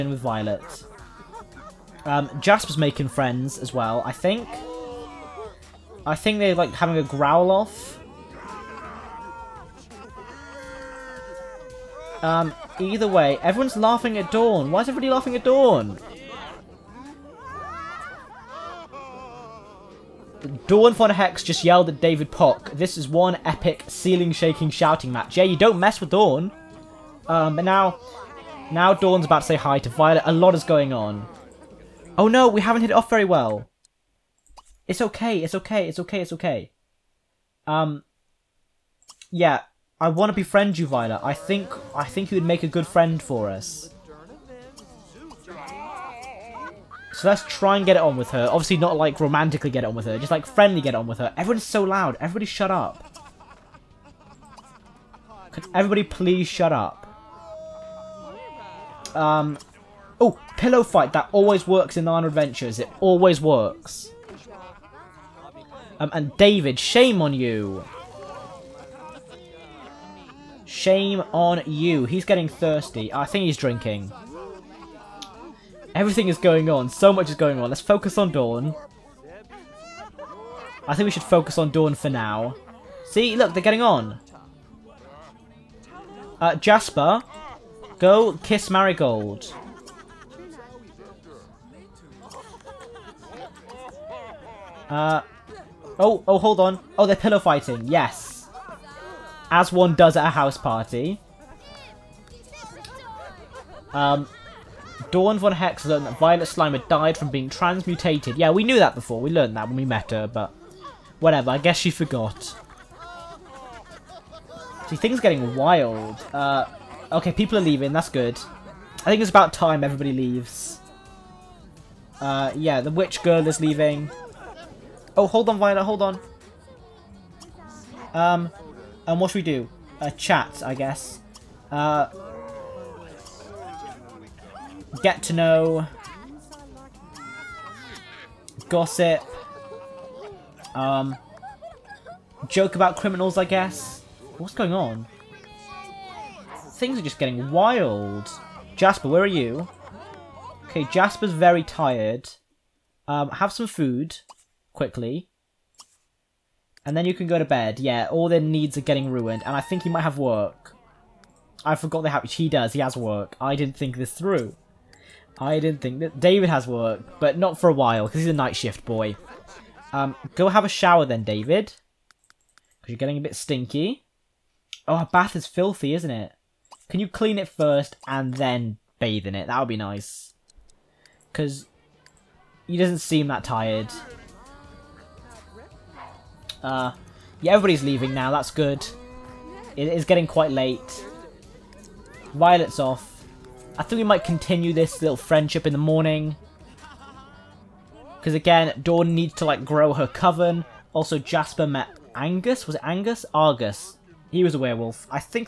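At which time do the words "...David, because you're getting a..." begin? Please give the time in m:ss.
2:51.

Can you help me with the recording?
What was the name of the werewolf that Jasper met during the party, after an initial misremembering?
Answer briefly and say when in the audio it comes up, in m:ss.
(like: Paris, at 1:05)
Argus, at 3:23.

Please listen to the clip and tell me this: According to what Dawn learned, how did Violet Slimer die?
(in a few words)
Transmutated.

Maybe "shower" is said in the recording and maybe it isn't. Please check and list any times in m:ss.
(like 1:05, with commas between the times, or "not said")
2:50.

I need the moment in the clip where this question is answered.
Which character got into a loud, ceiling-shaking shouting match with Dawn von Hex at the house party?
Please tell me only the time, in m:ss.
0:22.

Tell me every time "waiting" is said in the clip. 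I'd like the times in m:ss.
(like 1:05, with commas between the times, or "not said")
not said.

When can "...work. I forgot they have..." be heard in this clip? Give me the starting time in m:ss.
2:40.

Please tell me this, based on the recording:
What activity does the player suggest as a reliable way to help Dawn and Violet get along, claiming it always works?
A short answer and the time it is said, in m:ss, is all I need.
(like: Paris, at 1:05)
Pillow fight, at 1:00.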